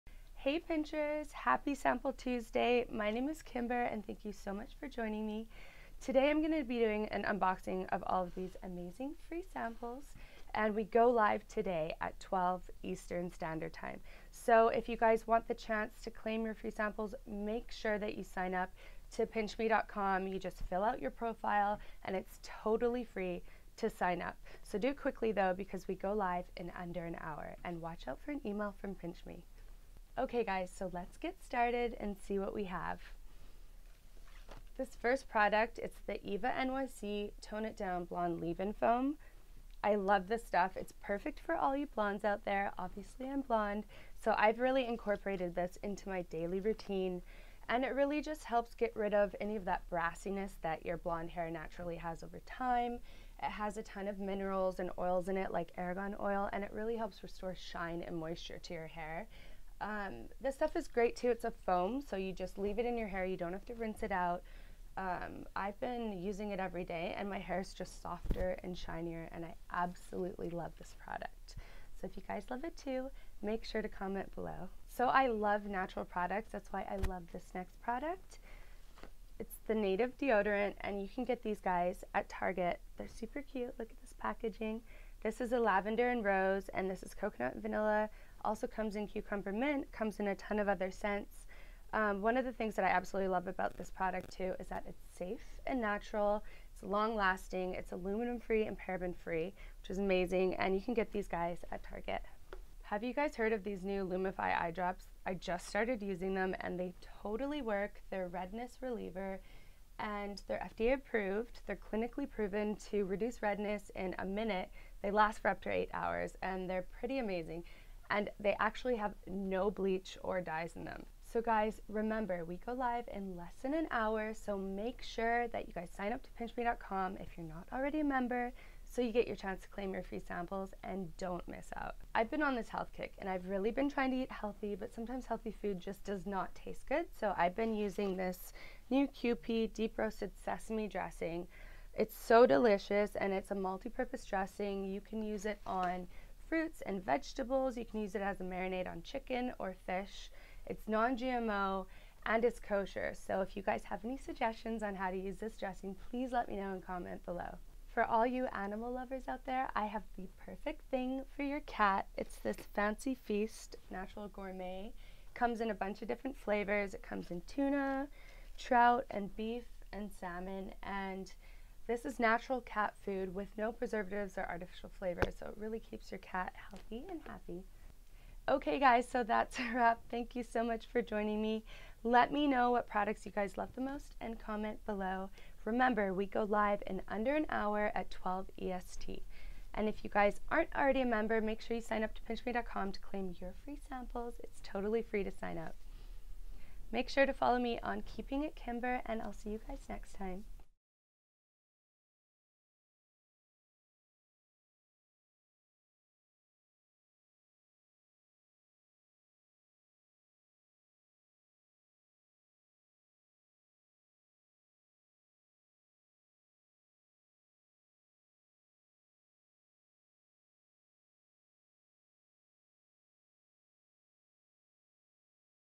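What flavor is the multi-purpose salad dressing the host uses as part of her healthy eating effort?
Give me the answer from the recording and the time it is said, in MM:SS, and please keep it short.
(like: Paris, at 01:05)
deep roasted sesame, at 02:19.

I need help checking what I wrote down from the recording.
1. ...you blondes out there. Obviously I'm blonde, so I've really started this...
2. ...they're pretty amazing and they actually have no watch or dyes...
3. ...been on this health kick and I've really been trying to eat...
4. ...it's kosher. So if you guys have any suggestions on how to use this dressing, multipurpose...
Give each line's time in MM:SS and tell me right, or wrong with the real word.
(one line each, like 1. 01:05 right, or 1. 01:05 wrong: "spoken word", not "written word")
1. 00:41 wrong: "incorporated", not "started"
2. 01:56 wrong: "bleach", not "watch"
3. 02:12 right
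4. 02:32 wrong: "please", not "multipurpose".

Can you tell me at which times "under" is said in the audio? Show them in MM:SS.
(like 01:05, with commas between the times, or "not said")
00:26, 03:07.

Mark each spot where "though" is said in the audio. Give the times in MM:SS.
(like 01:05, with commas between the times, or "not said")
00:25.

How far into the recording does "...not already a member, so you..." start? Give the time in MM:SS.
02:07.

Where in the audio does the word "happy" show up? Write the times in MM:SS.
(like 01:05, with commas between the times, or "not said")
00:01, 02:57.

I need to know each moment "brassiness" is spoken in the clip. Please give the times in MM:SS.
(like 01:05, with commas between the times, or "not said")
00:49.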